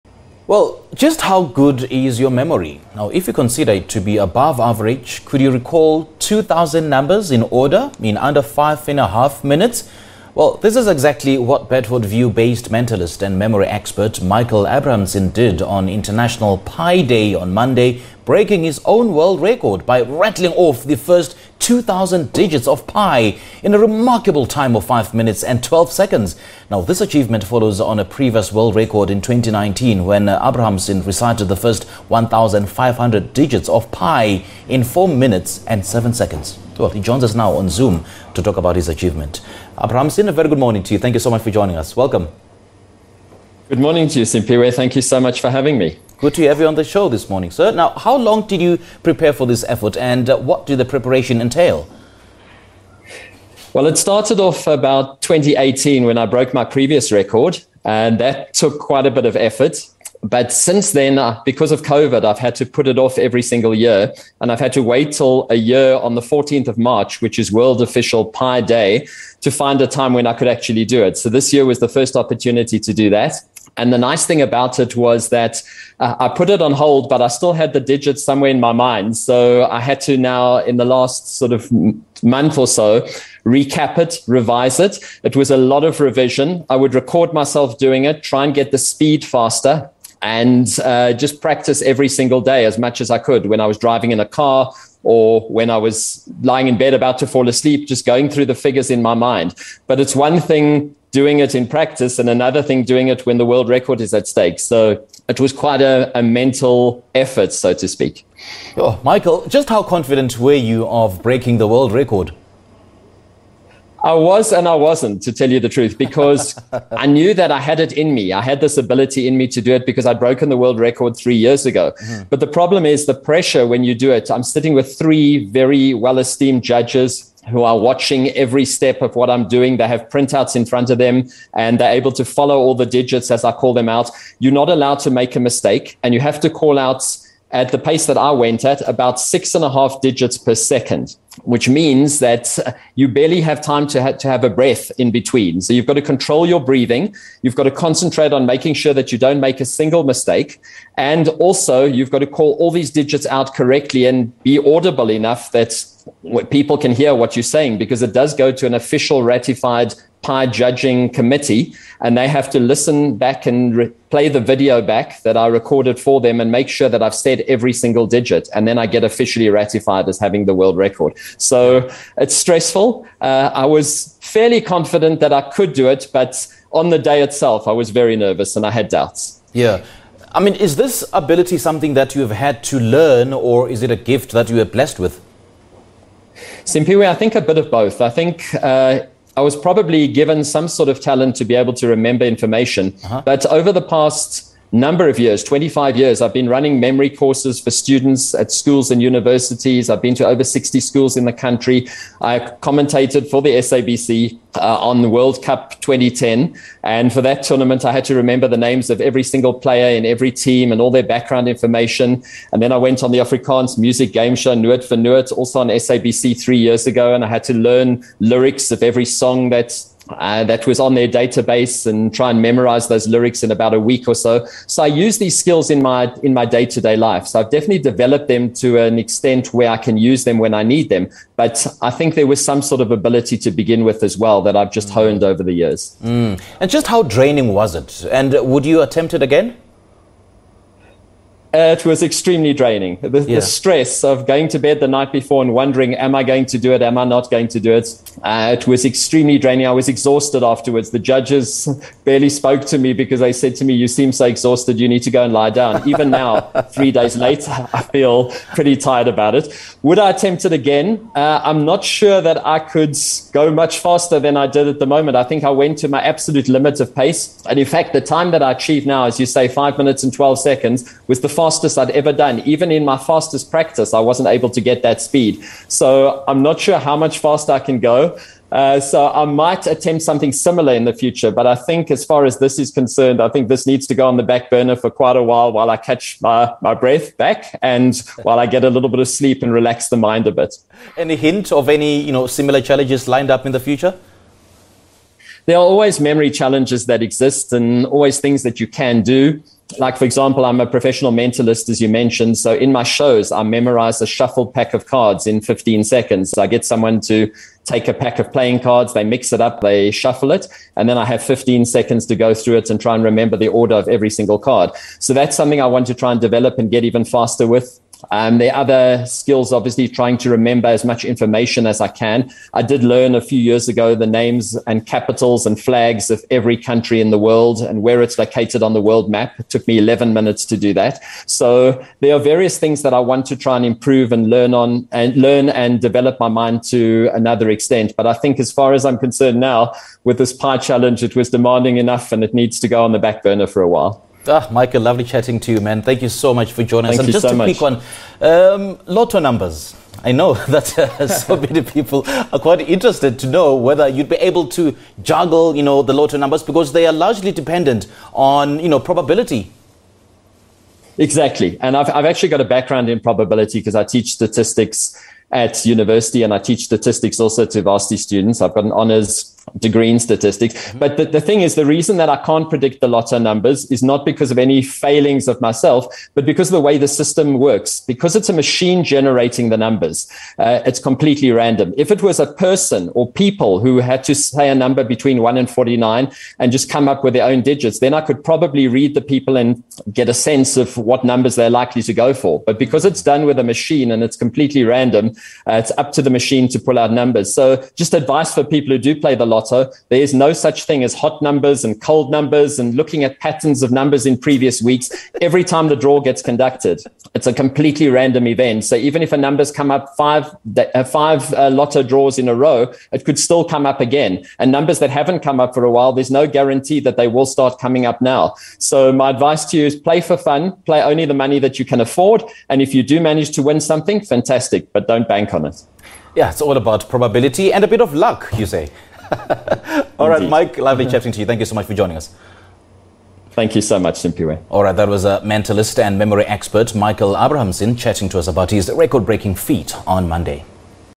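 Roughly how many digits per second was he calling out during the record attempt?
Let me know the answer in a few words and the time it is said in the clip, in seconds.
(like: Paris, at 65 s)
6.5, at 139 s.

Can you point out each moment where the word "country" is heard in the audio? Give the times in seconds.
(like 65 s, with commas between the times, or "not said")
201 s, 326 s.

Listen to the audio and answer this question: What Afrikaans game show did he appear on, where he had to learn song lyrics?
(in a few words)
Noot vir Noot.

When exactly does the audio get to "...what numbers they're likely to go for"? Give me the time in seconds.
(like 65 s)
390 s.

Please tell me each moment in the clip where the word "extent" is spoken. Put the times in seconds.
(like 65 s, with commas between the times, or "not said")
228 s, 337 s.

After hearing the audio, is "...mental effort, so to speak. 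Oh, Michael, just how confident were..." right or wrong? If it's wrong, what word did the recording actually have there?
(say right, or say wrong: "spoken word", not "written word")
right.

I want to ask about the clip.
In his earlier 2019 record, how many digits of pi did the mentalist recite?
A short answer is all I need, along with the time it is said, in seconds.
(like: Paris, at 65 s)
1,500, at 32 s.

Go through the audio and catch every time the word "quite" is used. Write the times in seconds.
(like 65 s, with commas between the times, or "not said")
58 s, 105 s, 285 s, 352 s.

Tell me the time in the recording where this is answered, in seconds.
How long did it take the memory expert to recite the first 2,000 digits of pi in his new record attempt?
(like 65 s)
24 s.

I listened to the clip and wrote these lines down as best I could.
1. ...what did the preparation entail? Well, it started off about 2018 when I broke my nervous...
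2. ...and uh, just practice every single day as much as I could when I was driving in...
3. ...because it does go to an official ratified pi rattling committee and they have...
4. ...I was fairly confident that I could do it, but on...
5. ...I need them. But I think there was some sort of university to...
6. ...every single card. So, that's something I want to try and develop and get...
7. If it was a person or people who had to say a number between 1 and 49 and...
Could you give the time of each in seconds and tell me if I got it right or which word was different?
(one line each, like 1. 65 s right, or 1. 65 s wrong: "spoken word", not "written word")
1. 50 s wrong: "previous", not "nervous"
2. 90 s right
3. 157 s wrong: "judging", not "rattling"
4. 173 s right
5. 230 s wrong: "ability", not "university"
6. 313 s right
7. 381 s right.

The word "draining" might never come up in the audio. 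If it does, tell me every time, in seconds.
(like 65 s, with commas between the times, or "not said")
237 s, 242 s, 249 s.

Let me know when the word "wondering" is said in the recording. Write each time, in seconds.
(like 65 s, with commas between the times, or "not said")
245 s.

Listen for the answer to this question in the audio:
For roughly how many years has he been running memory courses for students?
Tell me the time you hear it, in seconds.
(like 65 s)
195 s.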